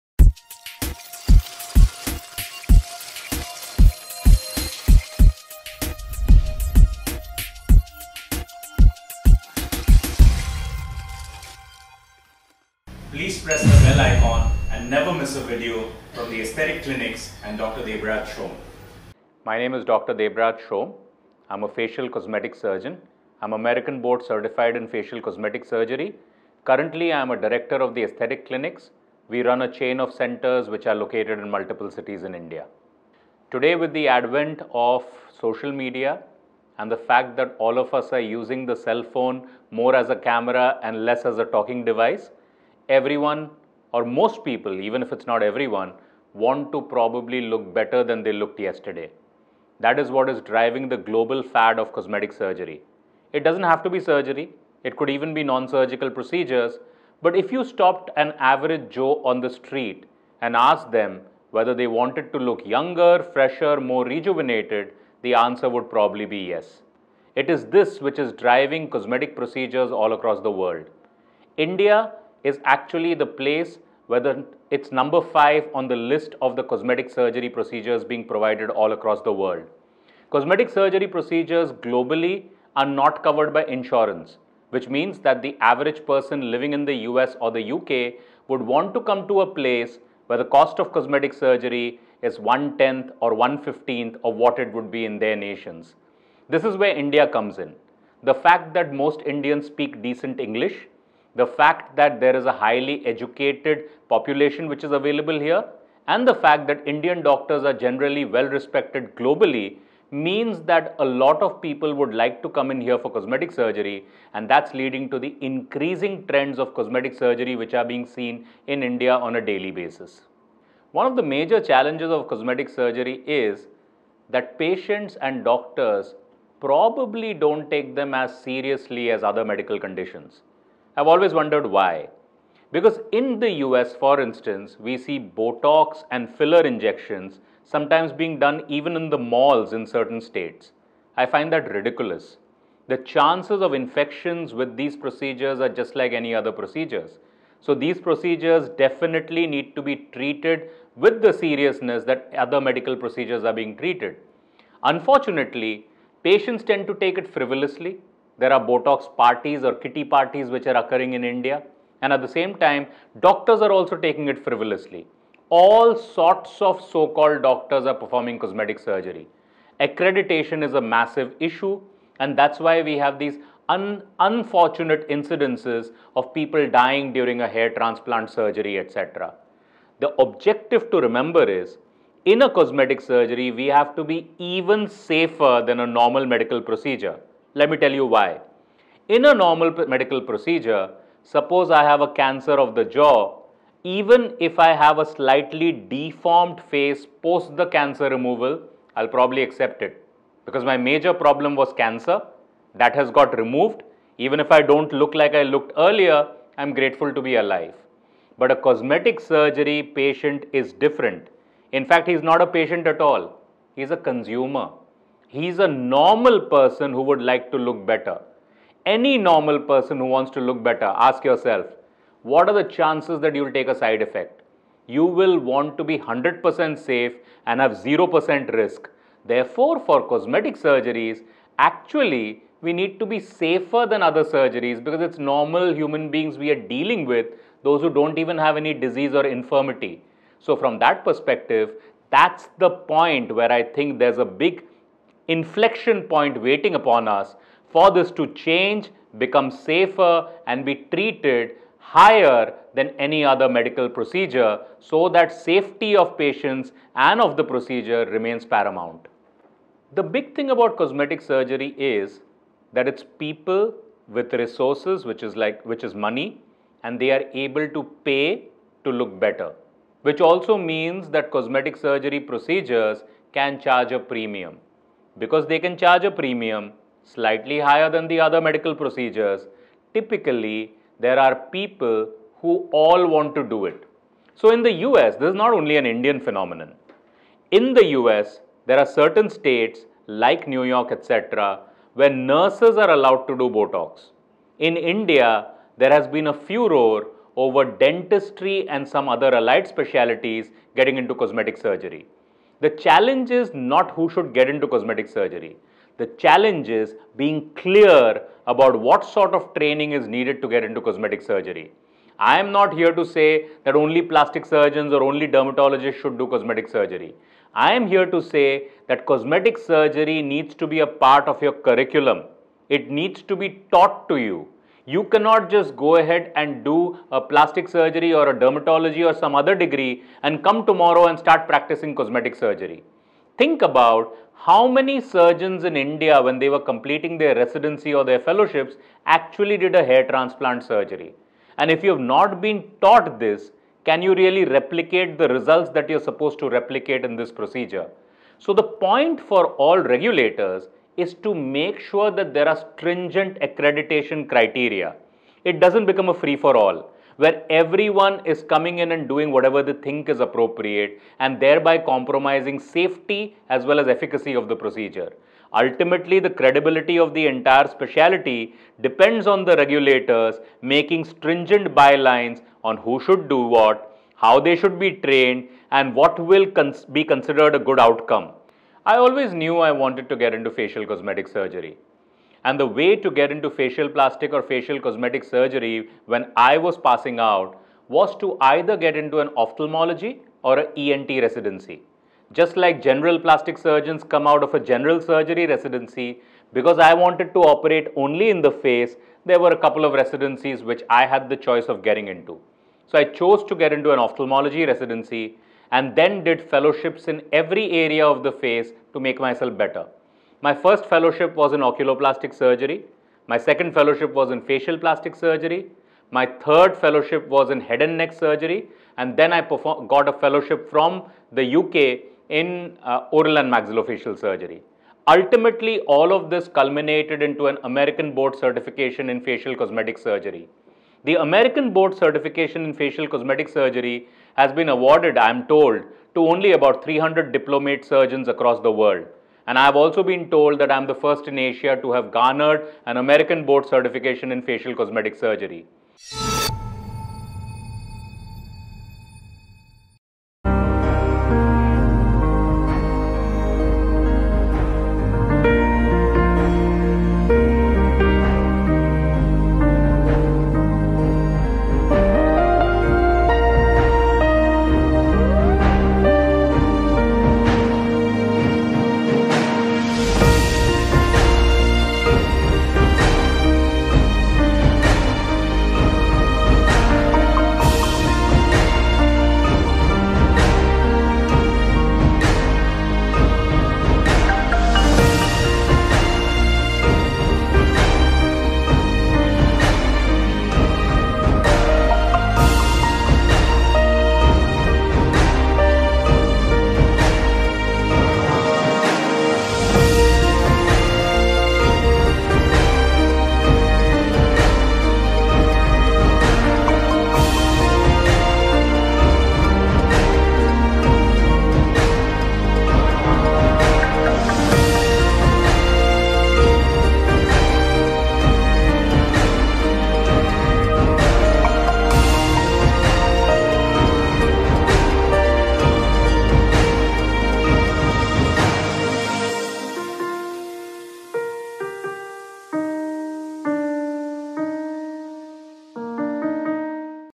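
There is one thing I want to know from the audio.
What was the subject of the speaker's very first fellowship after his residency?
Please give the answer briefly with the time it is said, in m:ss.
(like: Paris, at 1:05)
Oculoplastic surgery, at 6:51.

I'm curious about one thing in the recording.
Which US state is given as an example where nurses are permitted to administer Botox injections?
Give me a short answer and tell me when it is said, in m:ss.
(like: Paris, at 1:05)
New York, at 4:50.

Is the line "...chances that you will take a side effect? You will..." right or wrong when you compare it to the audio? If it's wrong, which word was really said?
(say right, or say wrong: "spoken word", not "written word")
right.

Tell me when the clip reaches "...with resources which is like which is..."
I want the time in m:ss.
4:24.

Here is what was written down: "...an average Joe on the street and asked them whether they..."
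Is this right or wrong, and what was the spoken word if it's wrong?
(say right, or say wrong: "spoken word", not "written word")
right.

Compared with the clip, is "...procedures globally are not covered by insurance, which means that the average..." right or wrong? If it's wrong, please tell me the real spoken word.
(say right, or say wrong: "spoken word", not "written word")
right.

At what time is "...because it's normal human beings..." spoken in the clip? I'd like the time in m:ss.
3:54.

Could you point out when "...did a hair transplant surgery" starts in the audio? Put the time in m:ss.
5:39.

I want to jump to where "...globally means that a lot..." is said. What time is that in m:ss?
1:49.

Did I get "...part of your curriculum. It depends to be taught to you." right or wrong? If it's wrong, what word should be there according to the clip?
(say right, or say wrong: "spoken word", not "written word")
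wrong: "needs", not "depends".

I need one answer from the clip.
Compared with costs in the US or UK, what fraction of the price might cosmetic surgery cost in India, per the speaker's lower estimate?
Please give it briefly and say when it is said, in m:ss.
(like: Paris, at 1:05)
one-fifteenth, at 1:33.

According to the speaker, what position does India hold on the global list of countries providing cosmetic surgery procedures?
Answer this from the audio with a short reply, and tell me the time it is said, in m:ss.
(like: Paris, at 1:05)
5, at 1:15.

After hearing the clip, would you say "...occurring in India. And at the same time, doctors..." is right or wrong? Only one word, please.
right.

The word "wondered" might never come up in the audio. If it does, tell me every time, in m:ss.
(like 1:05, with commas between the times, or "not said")
2:11.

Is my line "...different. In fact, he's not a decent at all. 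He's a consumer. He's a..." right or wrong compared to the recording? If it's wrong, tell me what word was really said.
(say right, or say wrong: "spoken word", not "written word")
wrong: "patient", not "decent".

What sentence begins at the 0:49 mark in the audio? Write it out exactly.
That is what is driving the global fad of cosmetic surgery.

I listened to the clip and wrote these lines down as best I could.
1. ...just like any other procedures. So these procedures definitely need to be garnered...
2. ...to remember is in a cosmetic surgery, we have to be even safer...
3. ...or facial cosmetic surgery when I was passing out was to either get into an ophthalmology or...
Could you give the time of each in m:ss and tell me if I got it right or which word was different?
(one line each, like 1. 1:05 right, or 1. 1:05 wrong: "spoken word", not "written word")
1. 2:25 wrong: "treated", not "garnered"
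2. 3:00 right
3. 6:24 right.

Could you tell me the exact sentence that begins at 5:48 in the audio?
So the point for all regulators is to make sure that there are stringent accreditation criteria.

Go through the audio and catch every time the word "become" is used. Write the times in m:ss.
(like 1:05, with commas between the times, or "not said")
4:09, 5:55.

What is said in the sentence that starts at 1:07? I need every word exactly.
It is this which is driving cosmetic procedures all across the world.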